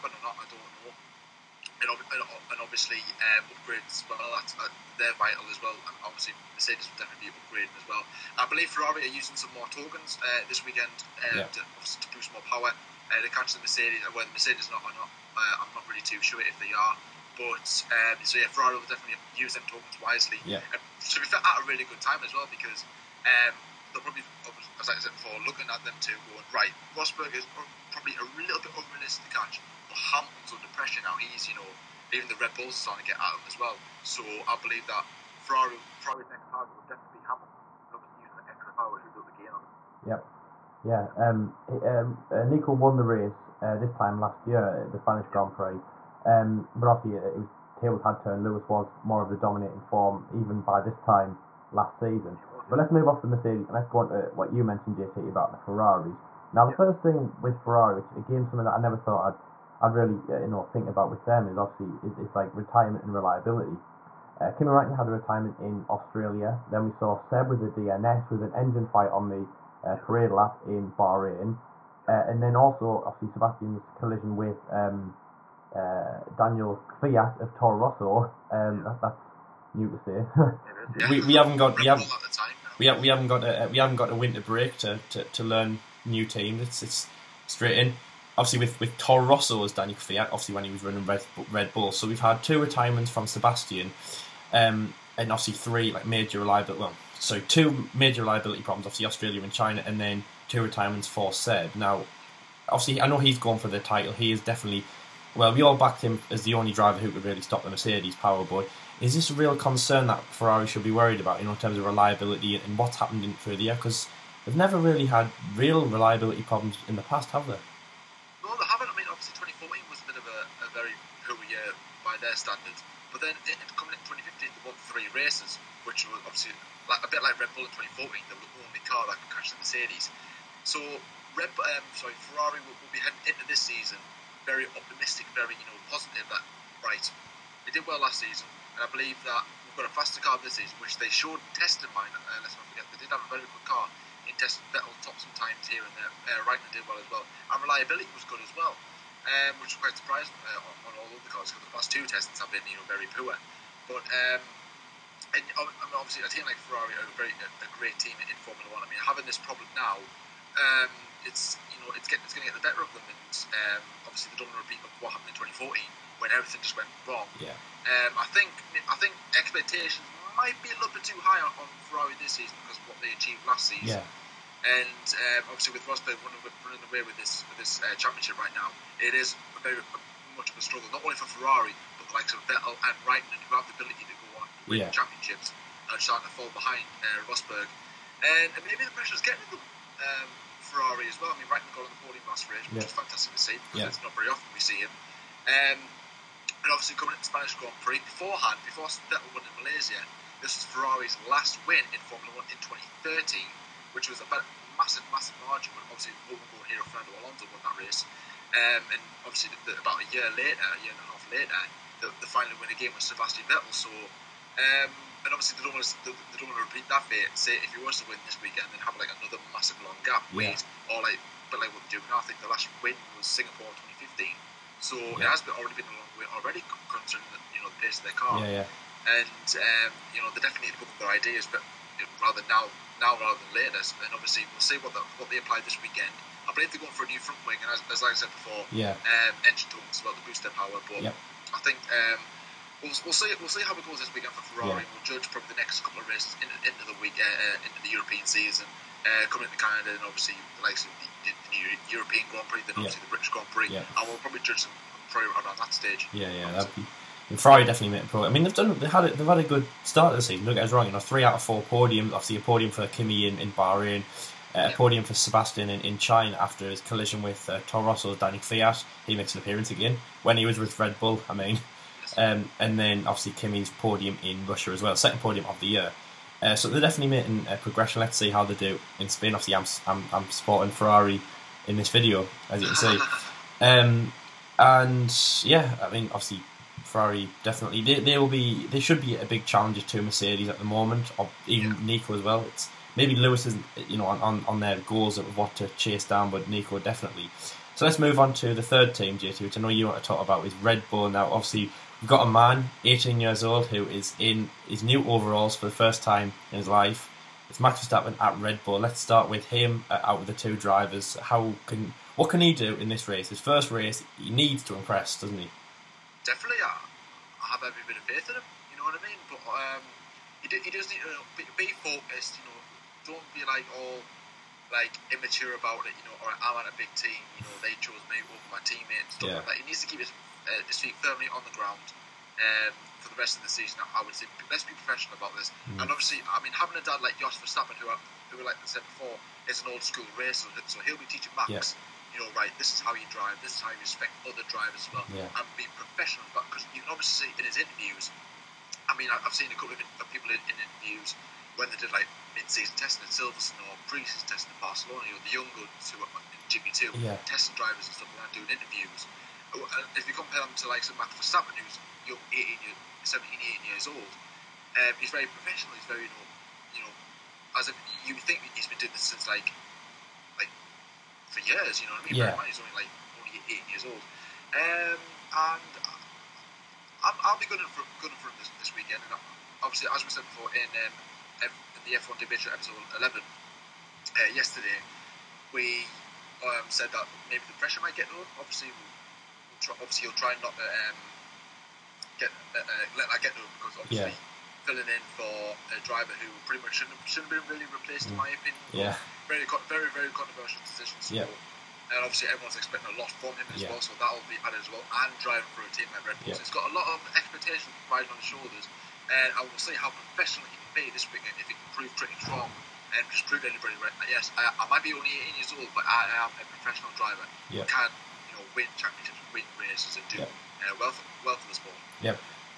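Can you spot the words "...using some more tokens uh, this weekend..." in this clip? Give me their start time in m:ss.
0:09.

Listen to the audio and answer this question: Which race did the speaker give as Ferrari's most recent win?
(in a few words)
Singapore 2015.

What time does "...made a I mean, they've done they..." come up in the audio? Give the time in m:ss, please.
4:17.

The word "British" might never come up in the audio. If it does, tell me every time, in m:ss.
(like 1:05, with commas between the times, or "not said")
4:13.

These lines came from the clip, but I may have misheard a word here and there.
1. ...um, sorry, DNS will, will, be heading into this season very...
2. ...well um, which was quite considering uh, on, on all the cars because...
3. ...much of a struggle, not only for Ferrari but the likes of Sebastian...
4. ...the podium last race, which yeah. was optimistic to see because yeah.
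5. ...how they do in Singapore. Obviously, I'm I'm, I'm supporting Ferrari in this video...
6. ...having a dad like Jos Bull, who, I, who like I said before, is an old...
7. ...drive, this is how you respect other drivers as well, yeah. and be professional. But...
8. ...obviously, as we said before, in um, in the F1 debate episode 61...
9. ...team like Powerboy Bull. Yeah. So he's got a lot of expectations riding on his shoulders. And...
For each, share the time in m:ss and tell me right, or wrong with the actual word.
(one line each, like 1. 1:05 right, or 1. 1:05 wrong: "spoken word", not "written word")
1. 2:11 wrong: "Ferrari", not "DNS"
2. 2:28 wrong: "surprising", not "considering"
3. 3:00 wrong: "Vettel", not "Sebastian"
4. 3:11 wrong: "fantastic", not "optimistic"
5. 4:38 wrong: "Spain", not "Singapore"
6. 5:36 wrong: "Verstappen", not "Bull"
7. 5:43 right
8. 6:19 wrong: "11", not "61"
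9. 6:45 wrong: "Red", not "Powerboy".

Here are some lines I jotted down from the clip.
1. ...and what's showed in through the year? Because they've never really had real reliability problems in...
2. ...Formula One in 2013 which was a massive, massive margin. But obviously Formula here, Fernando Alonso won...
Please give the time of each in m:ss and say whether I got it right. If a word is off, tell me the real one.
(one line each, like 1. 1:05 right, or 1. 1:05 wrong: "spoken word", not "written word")
1. 1:52 wrong: "happened", not "showed"
2. 3:22 wrong: "World", not "Formula".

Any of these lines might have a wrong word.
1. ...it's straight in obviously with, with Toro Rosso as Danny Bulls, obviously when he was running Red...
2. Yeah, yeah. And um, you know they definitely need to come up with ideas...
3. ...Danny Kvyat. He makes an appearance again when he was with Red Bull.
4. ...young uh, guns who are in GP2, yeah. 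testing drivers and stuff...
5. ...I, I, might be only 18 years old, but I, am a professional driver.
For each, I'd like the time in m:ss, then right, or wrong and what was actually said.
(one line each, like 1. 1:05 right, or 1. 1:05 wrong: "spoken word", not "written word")
1. 1:26 wrong: "Kvyat", not "Bulls"
2. 3:48 right
3. 4:28 right
4. 5:55 right
5. 6:54 right.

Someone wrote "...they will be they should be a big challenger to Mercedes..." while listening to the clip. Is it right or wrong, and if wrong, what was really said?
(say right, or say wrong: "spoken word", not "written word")
right.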